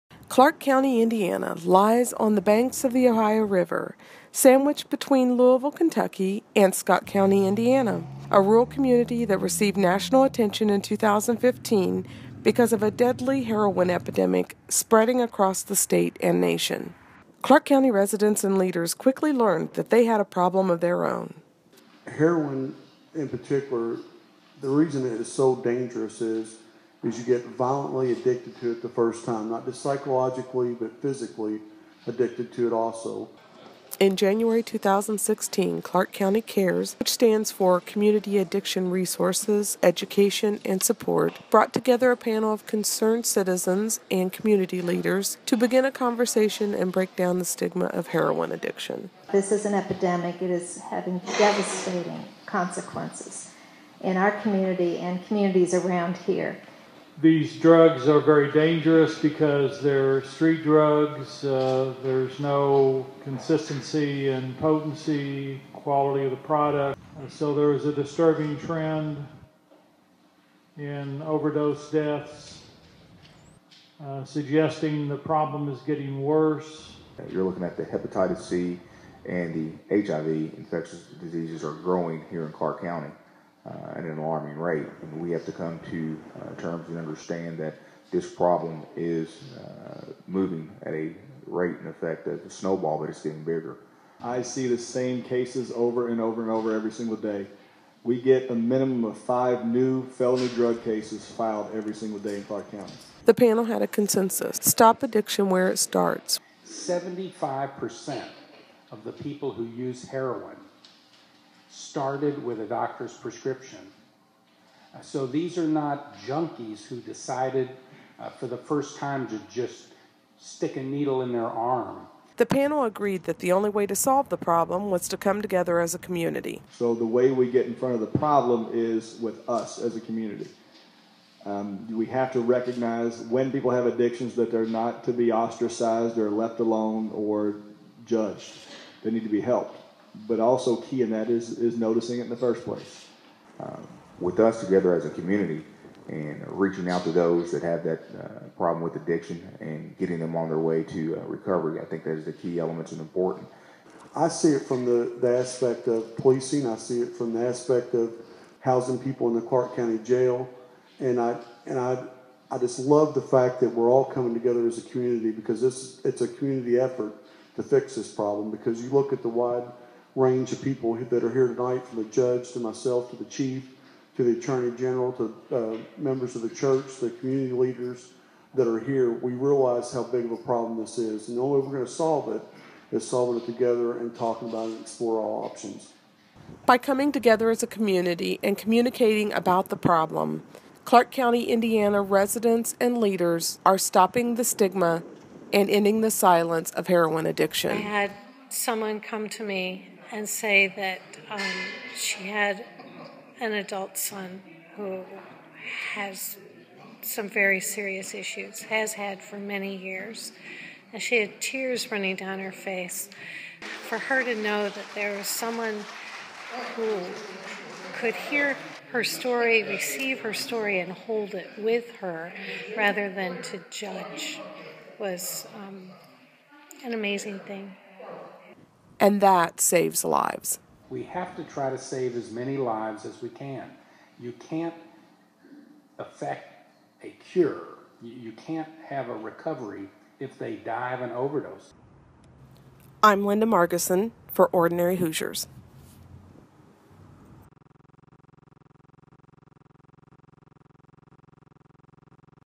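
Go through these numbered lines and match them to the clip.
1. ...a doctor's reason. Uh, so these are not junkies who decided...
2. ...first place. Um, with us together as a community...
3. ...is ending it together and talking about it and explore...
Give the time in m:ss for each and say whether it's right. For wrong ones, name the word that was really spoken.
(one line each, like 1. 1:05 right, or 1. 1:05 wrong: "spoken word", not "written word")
1. 1:52 wrong: "prescription", not "reason"
2. 2:22 right
3. 3:02 wrong: "solving", not "ending".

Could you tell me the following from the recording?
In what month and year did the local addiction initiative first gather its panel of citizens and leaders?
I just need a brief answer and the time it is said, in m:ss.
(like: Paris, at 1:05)
January 2016, at 0:34.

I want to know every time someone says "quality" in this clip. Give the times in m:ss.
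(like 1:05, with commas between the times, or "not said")
1:05.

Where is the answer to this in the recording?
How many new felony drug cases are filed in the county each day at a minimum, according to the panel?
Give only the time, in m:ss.
1:39.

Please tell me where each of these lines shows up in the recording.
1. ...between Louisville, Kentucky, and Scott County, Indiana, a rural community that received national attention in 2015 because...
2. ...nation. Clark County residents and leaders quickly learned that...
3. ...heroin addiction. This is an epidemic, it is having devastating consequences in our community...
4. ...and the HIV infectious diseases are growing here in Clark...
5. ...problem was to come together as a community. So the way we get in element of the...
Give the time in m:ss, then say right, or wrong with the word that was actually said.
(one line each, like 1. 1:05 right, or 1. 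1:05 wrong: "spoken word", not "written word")
1. 0:04 right
2. 0:16 right
3. 0:48 right
4. 1:19 right
5. 2:04 wrong: "front", not "element".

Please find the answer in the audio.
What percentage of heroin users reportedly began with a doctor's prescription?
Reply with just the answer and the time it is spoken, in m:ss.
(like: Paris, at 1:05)
75%, at 1:46.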